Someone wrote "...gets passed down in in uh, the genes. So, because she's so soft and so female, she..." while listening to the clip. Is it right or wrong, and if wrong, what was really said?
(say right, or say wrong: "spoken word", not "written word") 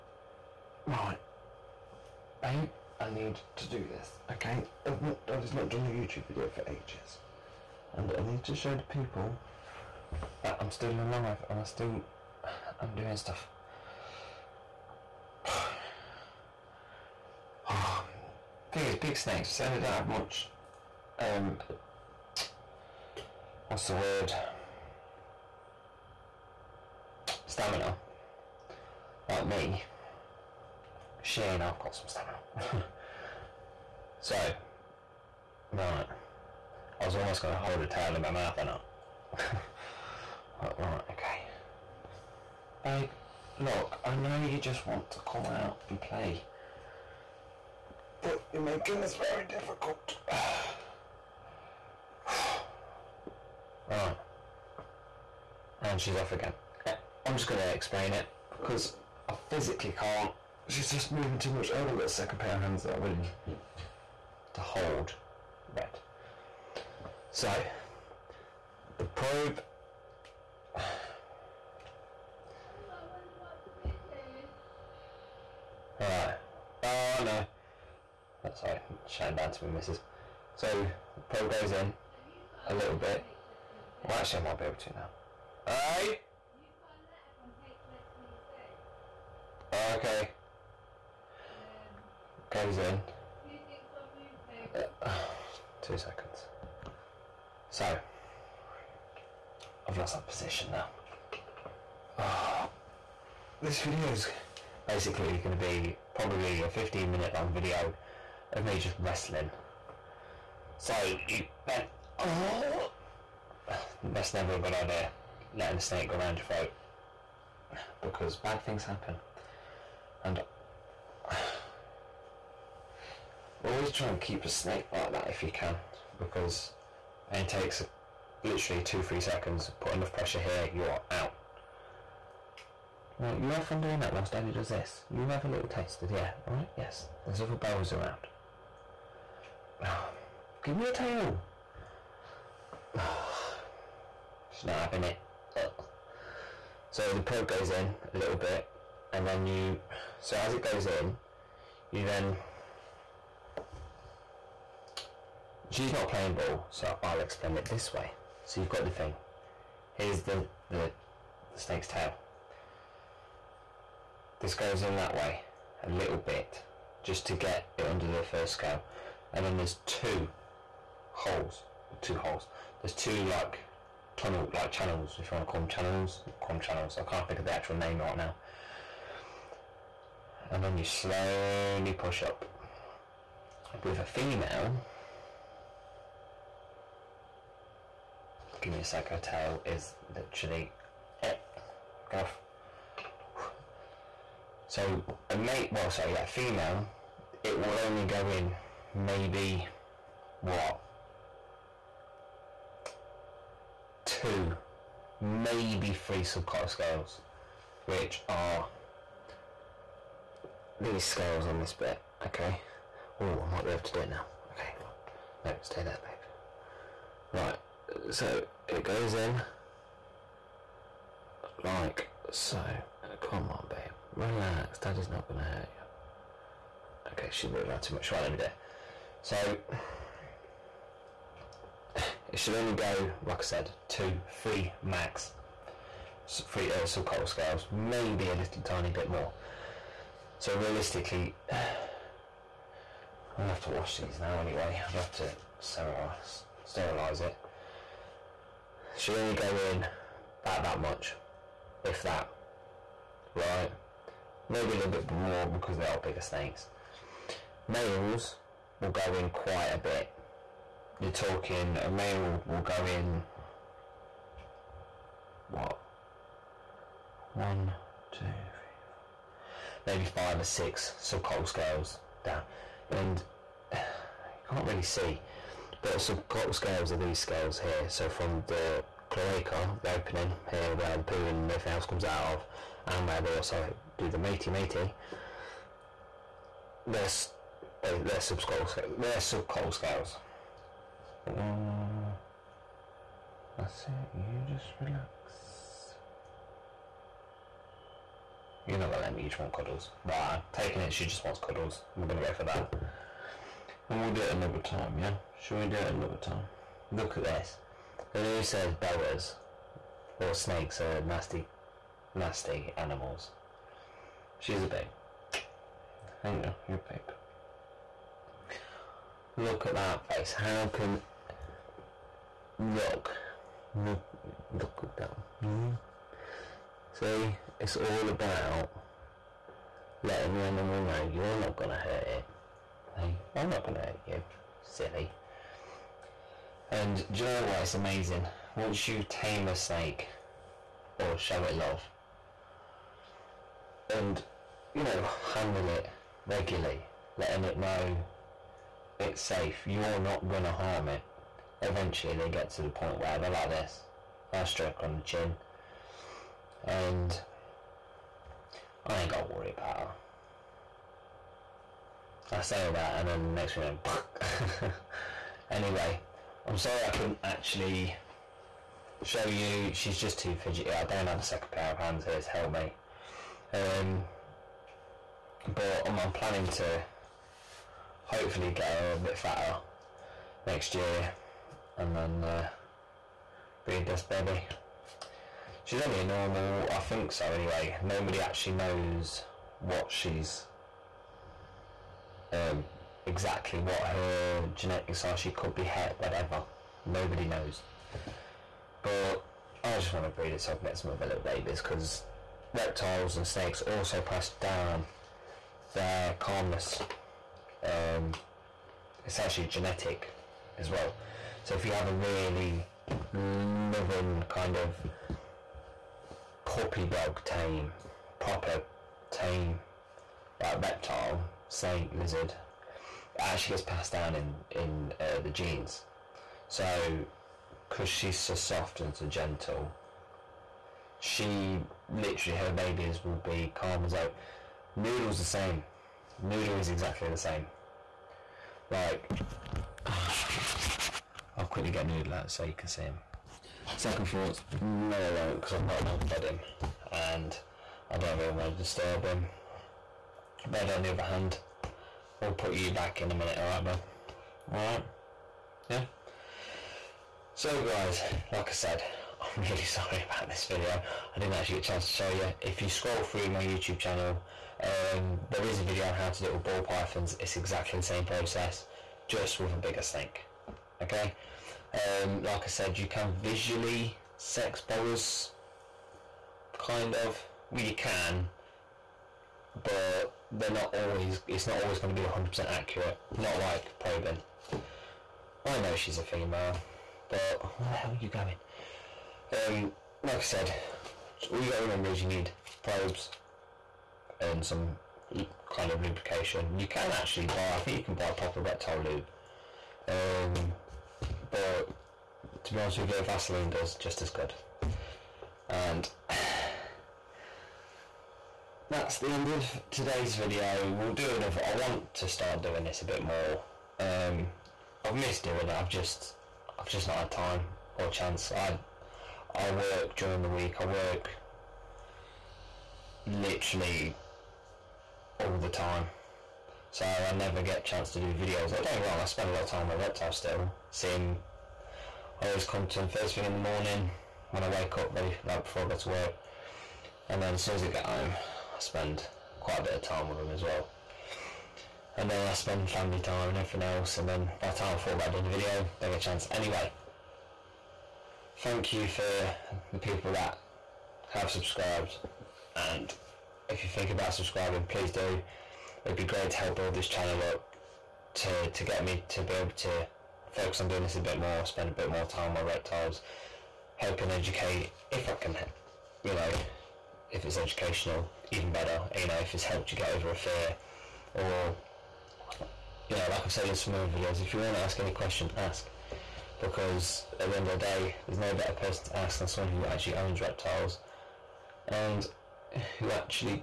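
wrong: "gentle", not "female".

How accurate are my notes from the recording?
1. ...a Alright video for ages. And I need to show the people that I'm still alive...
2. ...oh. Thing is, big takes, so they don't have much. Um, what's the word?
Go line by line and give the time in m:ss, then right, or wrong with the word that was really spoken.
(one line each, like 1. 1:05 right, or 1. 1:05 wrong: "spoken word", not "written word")
1. 0:05 wrong: "YouTube", not "Alright"
2. 0:17 wrong: "snakes", not "takes".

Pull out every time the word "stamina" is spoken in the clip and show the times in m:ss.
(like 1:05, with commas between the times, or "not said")
0:27, 0:32.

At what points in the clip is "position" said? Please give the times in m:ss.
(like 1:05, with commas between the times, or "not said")
1:40.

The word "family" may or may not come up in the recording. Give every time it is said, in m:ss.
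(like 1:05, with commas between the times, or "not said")
9:02.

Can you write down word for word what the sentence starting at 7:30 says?
Red, on the other hand, we'll put you back in a minute, alright, babe?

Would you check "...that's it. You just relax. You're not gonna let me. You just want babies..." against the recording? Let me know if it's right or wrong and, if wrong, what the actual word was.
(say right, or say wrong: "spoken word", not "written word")
wrong: "cuddles", not "babies".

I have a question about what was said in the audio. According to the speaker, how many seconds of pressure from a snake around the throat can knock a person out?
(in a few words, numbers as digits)
2, 3 seconds.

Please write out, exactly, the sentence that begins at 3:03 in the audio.
With a female, give me a sec, her tail is literally it.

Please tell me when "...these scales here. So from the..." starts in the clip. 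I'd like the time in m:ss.
4:36.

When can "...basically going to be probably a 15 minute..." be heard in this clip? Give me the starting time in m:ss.
1:44.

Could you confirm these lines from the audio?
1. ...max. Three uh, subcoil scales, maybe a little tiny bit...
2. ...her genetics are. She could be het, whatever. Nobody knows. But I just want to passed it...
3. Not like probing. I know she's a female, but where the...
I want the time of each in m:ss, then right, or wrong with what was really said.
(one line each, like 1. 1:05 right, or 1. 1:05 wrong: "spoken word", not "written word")
1. 3:54 right
2. 6:33 wrong: "breed", not "passed"
3. 8:03 right.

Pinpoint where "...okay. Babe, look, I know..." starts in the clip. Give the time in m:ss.
0:41.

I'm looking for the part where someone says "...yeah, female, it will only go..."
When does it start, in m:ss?
3:16.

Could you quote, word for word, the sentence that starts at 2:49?
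And then there's two holes, two holes.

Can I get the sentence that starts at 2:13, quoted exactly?
Right, you have fun doing that whilst Daddy does this.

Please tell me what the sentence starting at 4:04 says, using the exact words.
i have to sterilize, sterilize it.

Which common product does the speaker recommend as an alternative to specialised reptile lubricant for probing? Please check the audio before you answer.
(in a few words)
Vaseline.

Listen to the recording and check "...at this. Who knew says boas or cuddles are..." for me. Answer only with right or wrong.
wrong.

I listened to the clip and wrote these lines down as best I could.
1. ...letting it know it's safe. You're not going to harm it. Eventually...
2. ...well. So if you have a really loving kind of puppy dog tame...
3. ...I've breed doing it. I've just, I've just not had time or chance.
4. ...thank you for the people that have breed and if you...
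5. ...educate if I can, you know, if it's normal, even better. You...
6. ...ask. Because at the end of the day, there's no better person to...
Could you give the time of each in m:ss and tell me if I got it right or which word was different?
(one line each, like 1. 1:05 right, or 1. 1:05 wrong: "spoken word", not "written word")
1. 5:47 right
2. 6:50 right
3. 8:34 wrong: "missed", not "breed"
4. 9:08 wrong: "subscribed", not "breed"
5. 9:24 wrong: "educational", not "normal"
6. 9:35 right.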